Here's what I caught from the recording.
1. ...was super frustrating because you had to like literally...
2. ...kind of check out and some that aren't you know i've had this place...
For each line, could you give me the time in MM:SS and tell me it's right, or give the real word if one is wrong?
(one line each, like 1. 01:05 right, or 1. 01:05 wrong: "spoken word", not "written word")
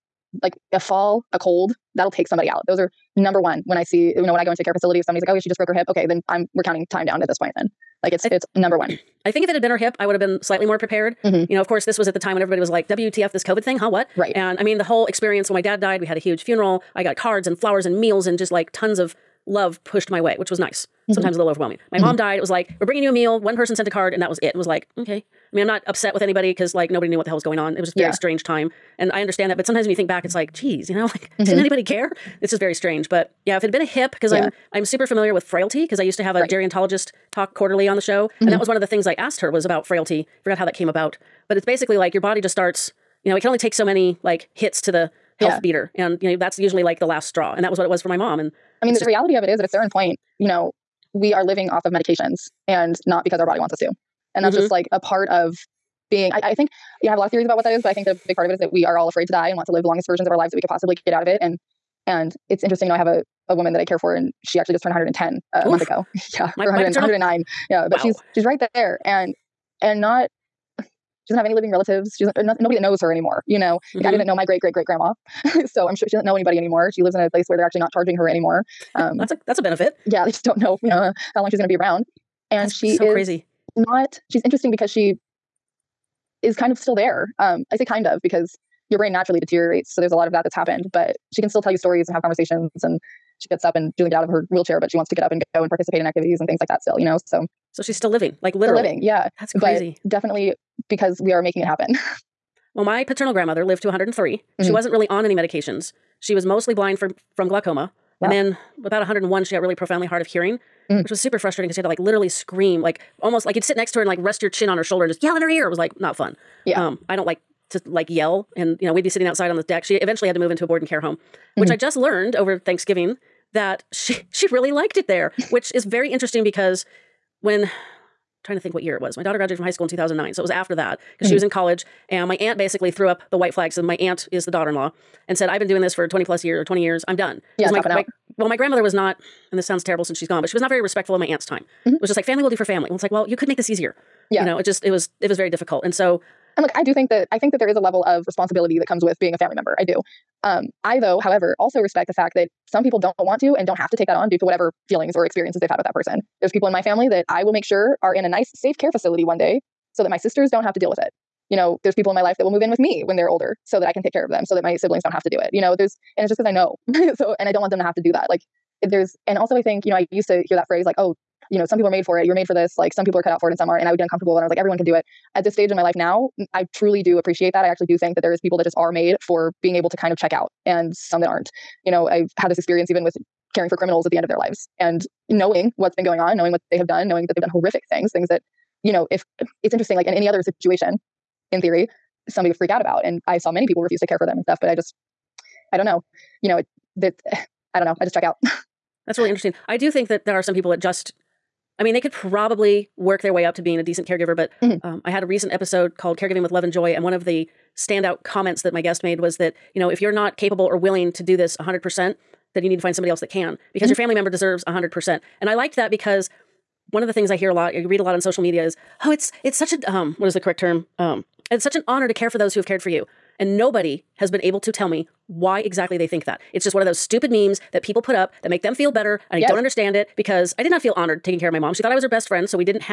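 1. 01:51 right
2. 02:59 wrong: "experience", not "place".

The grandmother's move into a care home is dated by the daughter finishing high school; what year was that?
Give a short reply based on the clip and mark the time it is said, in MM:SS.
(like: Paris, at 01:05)
2009, at 02:09.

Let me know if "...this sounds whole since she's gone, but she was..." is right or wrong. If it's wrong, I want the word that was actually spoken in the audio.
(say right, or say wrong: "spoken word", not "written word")
wrong: "terrible", not "whole".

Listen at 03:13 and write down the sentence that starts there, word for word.
And I saw many people refuse to care for them and stuff, but I just, I don't know.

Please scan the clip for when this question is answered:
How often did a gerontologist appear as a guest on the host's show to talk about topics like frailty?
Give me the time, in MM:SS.
00:37.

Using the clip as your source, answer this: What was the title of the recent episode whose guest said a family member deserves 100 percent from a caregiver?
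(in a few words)
Caregiving with Love and Joy.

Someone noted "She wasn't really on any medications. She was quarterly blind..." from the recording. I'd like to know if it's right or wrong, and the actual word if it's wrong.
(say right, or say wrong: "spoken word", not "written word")
wrong: "mostly", not "quarterly".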